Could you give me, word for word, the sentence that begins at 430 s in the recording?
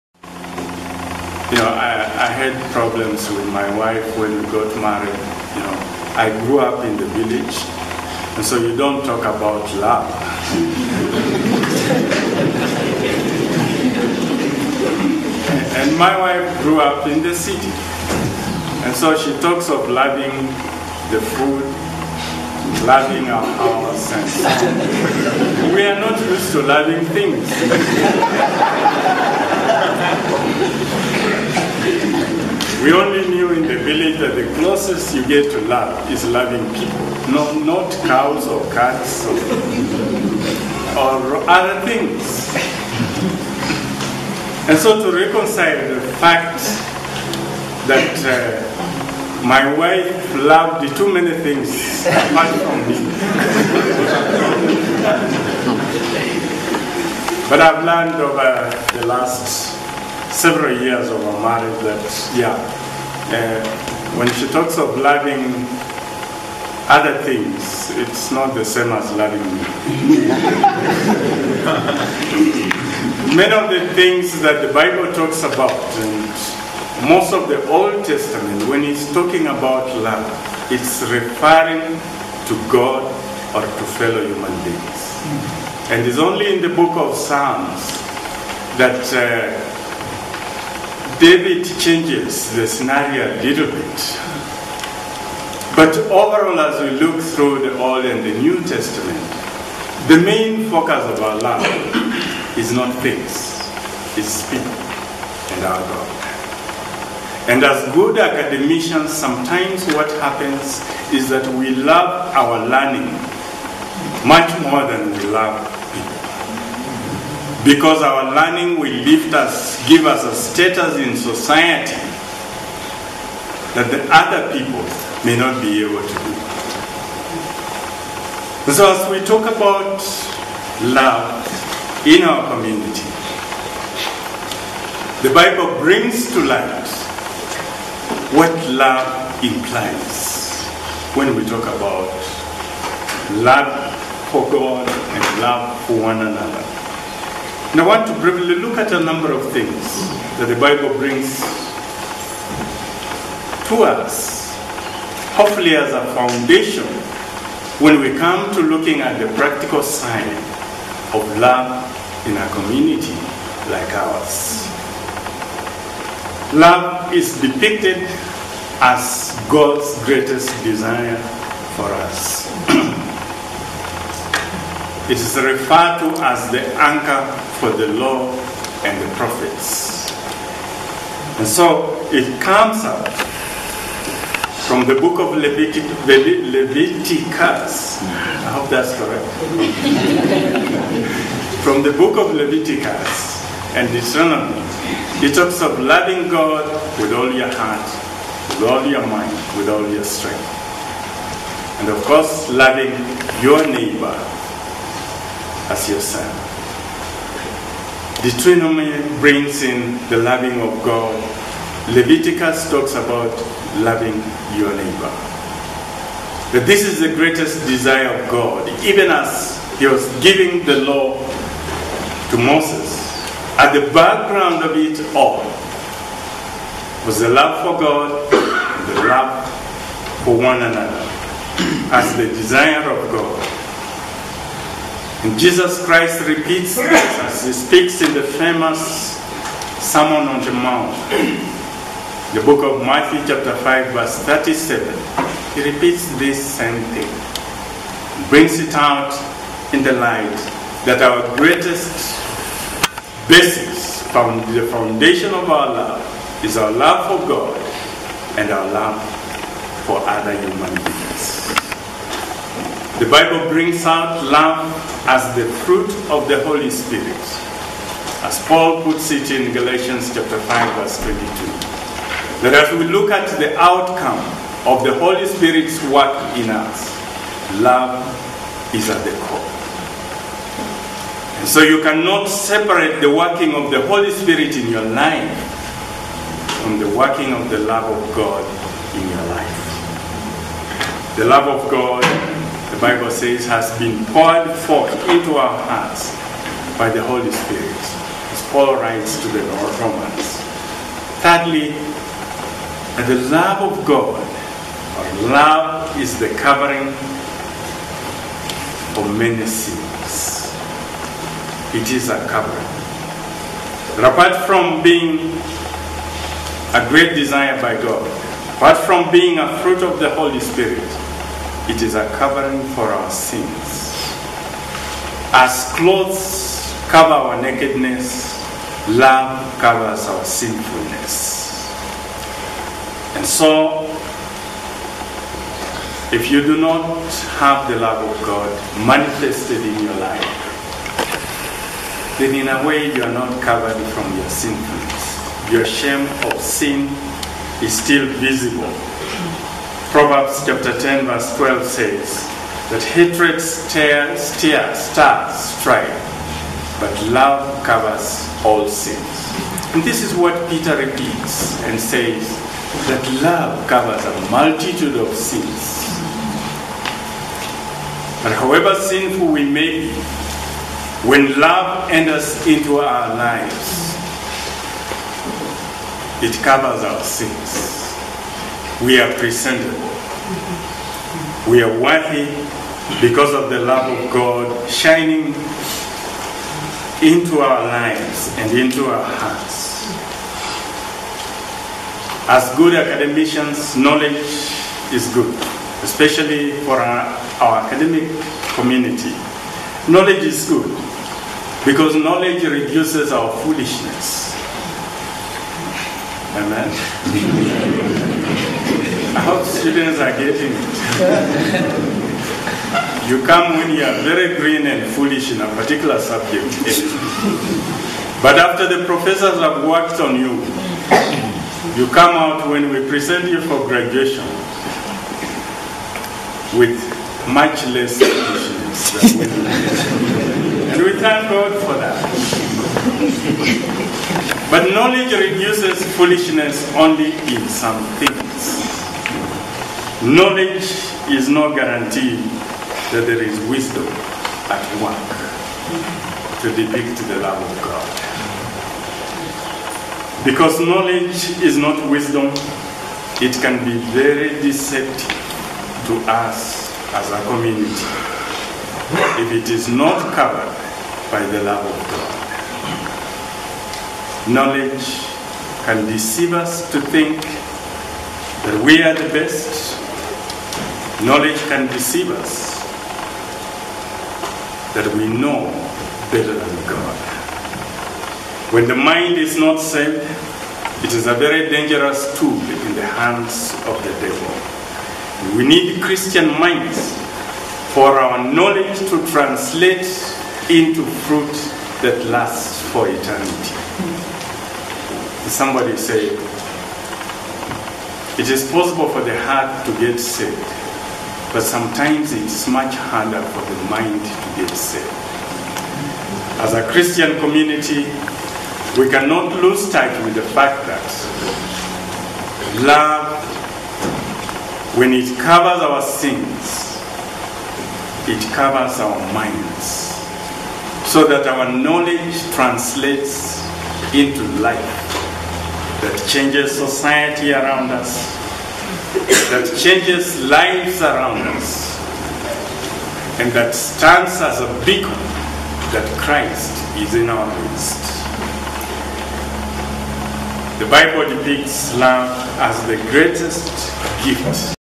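And we thank God for that.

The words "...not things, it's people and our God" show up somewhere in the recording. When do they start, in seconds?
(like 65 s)
102 s.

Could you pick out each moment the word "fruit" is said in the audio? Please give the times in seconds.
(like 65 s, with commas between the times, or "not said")
265 s, 319 s, 491 s.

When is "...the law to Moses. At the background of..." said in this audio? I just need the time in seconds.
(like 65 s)
220 s.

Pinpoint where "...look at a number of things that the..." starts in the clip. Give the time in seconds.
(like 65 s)
148 s.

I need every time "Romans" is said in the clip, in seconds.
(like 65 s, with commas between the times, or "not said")
299 s.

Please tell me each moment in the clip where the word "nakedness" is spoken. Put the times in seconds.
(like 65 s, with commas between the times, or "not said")
327 s.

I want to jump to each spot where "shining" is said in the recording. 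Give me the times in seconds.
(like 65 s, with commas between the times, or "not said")
384 s.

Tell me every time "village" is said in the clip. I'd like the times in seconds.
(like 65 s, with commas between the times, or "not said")
7 s, 33 s.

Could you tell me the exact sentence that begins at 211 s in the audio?
Leviticus talks about loving your neighbor.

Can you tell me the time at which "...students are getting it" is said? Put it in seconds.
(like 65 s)
409 s.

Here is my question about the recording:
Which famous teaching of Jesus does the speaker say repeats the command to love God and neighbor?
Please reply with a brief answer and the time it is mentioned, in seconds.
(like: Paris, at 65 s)
Sermon on the Mount, at 239 s.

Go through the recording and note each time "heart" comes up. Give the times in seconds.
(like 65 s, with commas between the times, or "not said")
197 s, 295 s, 389 s, 499 s.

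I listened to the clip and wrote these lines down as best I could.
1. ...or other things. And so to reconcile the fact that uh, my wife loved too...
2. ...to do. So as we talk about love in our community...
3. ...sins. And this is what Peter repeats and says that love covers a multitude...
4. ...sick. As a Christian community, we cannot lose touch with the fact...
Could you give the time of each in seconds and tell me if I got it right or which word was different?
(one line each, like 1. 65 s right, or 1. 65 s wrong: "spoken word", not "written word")
1. 40 s right
2. 126 s right
3. 358 s right
4. 504 s right.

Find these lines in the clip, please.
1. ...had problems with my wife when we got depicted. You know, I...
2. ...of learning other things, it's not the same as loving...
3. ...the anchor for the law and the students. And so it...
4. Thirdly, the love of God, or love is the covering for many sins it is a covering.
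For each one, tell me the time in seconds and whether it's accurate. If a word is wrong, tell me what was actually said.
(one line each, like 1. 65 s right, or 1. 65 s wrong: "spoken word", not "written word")
1. 2 s wrong: "married", not "depicted"
2. 64 s wrong: "loving", not "learning"
3. 176 s wrong: "prophets", not "students"
4. 301 s right.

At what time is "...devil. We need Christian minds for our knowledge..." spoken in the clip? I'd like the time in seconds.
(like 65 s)
484 s.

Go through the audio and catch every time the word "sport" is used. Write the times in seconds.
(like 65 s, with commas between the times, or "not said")
not said.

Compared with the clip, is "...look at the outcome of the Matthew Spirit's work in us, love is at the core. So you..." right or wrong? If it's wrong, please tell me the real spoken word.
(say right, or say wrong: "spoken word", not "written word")
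wrong: "Holy", not "Matthew".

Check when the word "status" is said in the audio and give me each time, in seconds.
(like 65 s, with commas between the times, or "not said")
120 s.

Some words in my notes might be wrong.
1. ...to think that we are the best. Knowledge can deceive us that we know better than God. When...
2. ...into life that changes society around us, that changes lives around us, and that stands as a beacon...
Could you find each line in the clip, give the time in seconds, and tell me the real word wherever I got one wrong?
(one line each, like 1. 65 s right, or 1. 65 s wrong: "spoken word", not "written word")
1. 466 s right
2. 523 s right.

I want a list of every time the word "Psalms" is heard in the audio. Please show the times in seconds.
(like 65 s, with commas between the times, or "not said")
87 s.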